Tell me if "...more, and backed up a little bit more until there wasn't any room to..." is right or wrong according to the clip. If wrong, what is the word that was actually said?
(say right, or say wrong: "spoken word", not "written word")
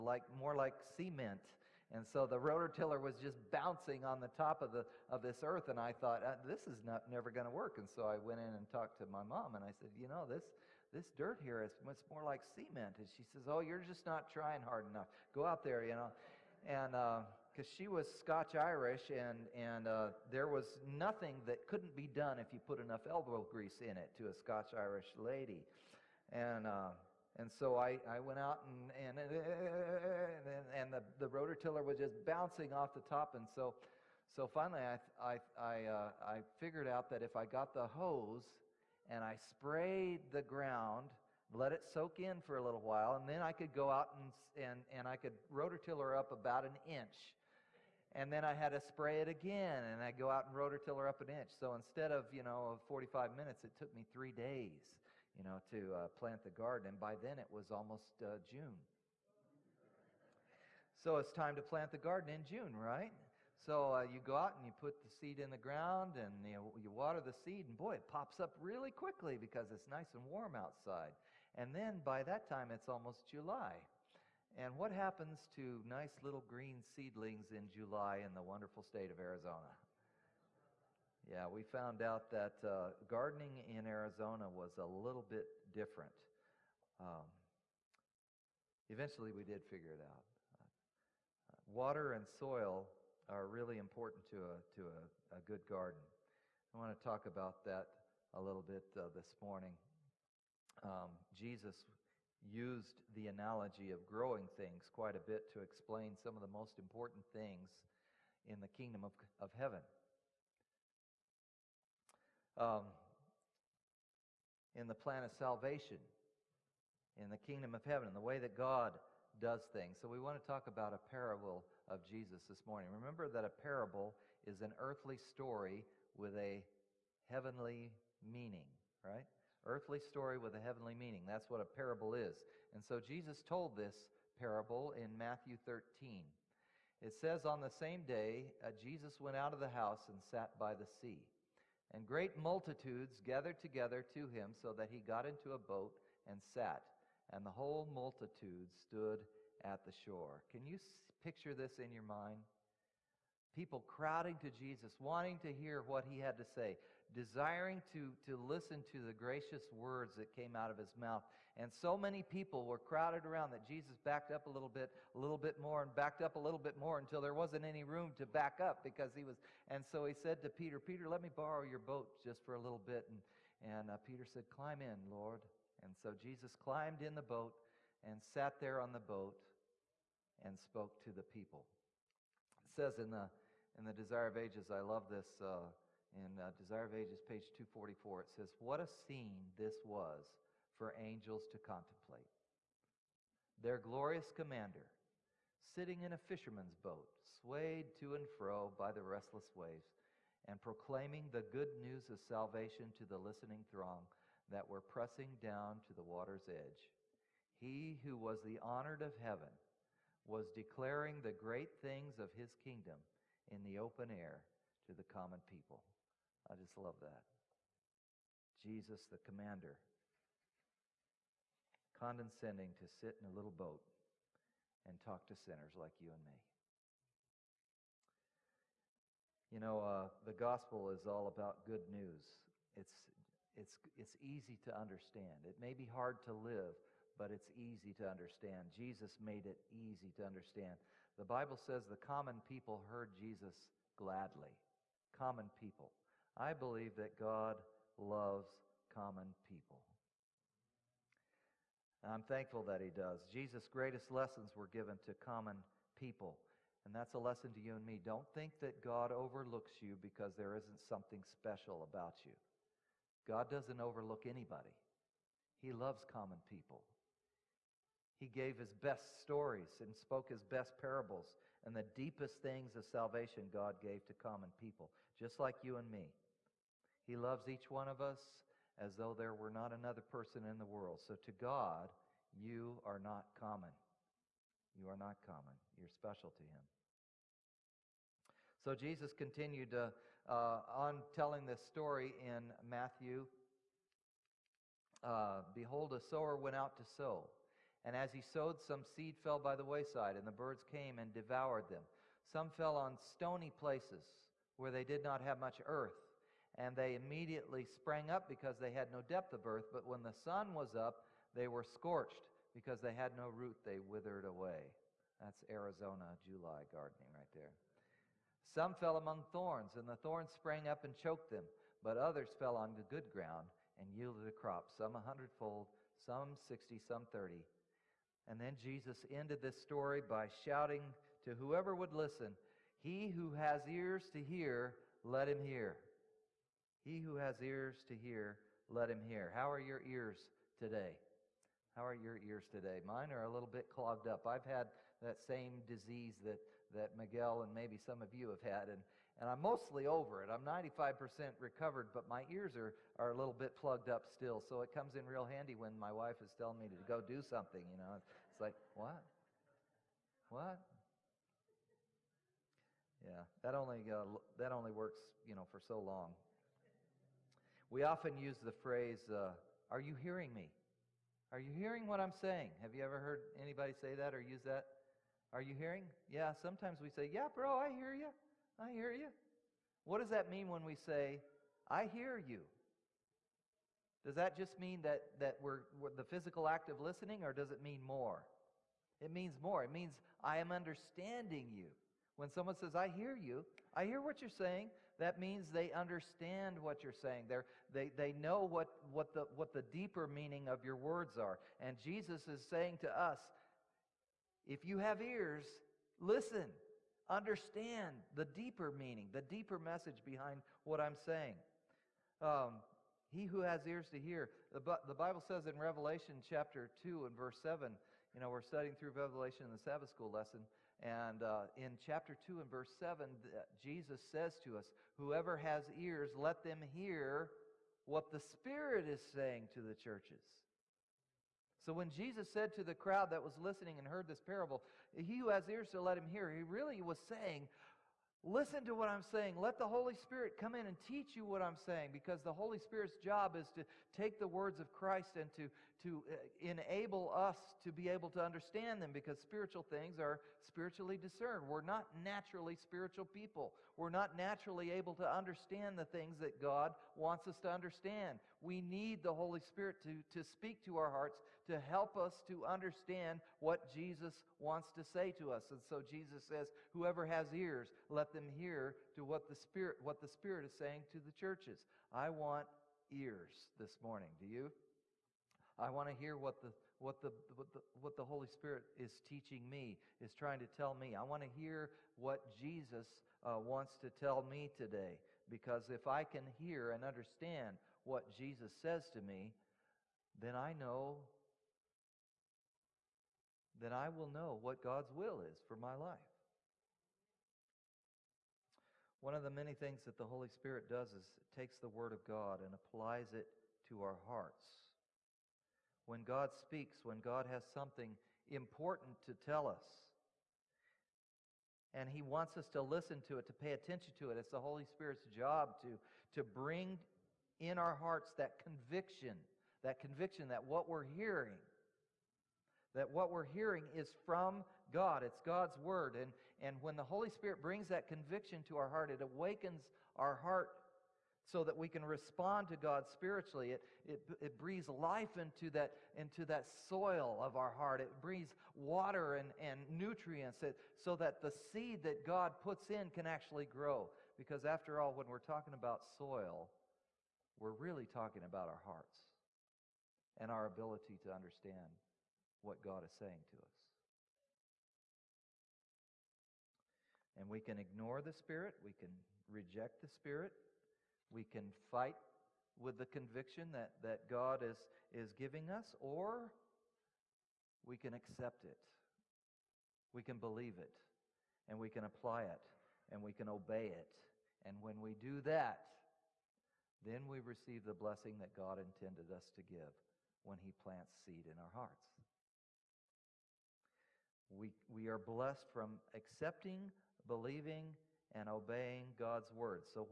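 right.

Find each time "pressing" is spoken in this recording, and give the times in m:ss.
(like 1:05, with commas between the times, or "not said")
3:24.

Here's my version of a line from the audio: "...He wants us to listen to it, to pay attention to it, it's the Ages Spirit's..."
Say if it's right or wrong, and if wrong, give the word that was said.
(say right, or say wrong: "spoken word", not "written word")
wrong: "Holy", not "Ages".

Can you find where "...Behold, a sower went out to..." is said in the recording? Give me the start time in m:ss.
4:55.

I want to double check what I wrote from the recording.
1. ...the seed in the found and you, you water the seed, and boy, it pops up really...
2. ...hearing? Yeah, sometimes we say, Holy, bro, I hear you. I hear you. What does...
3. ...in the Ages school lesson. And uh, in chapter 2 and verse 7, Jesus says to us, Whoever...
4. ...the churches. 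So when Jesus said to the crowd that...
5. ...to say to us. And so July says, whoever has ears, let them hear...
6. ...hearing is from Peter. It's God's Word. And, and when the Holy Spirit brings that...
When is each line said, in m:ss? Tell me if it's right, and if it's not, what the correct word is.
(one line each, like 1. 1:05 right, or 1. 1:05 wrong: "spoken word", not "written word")
1. 1:05 wrong: "ground", not "found"
2. 6:15 wrong: "Yeah", not "Holy"
3. 6:59 wrong: "Sabbath", not "Ages"
4. 7:09 right
5. 7:44 wrong: "Jesus", not "July"
6. 8:43 wrong: "God", not "Peter".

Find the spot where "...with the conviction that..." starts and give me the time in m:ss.
9:22.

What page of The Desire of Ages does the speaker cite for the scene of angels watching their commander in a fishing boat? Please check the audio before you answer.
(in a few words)
244.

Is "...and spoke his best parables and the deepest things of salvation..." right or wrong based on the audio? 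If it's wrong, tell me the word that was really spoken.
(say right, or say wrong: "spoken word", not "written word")
right.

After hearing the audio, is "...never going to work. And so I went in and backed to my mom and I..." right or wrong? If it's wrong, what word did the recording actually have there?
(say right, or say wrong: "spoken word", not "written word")
wrong: "talked", not "backed".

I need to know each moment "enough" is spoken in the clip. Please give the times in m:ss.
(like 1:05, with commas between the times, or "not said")
0:14, 0:22.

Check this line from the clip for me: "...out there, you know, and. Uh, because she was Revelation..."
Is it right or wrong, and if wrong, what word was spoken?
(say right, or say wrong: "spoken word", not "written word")
wrong: "Scotch", not "Revelation".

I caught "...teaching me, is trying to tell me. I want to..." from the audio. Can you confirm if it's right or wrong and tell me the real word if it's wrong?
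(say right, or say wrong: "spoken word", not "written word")
right.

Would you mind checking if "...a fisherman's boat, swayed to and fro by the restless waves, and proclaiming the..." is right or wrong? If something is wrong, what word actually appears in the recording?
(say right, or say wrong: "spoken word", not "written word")
right.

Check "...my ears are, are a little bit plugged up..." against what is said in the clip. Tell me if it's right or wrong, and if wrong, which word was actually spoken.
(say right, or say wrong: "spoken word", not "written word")
right.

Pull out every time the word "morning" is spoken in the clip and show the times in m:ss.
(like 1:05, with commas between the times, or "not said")
1:39, 2:02, 7:53.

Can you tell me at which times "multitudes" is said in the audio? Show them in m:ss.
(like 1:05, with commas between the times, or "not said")
2:22, 2:27.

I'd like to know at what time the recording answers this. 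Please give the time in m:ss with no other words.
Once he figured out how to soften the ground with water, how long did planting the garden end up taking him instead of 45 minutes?
0:54.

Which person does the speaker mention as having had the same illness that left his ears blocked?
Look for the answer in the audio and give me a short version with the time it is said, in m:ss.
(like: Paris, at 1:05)
Miguel, at 5:46.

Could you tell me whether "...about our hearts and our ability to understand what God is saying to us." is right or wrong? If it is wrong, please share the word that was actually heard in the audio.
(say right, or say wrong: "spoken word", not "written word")
right.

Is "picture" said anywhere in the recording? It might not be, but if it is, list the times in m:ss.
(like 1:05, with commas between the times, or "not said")
2:31.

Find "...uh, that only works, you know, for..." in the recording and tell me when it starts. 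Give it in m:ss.
6:03.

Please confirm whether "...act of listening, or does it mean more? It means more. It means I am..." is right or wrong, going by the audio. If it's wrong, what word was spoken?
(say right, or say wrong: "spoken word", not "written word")
right.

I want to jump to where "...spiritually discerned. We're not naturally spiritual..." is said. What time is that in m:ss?
7:30.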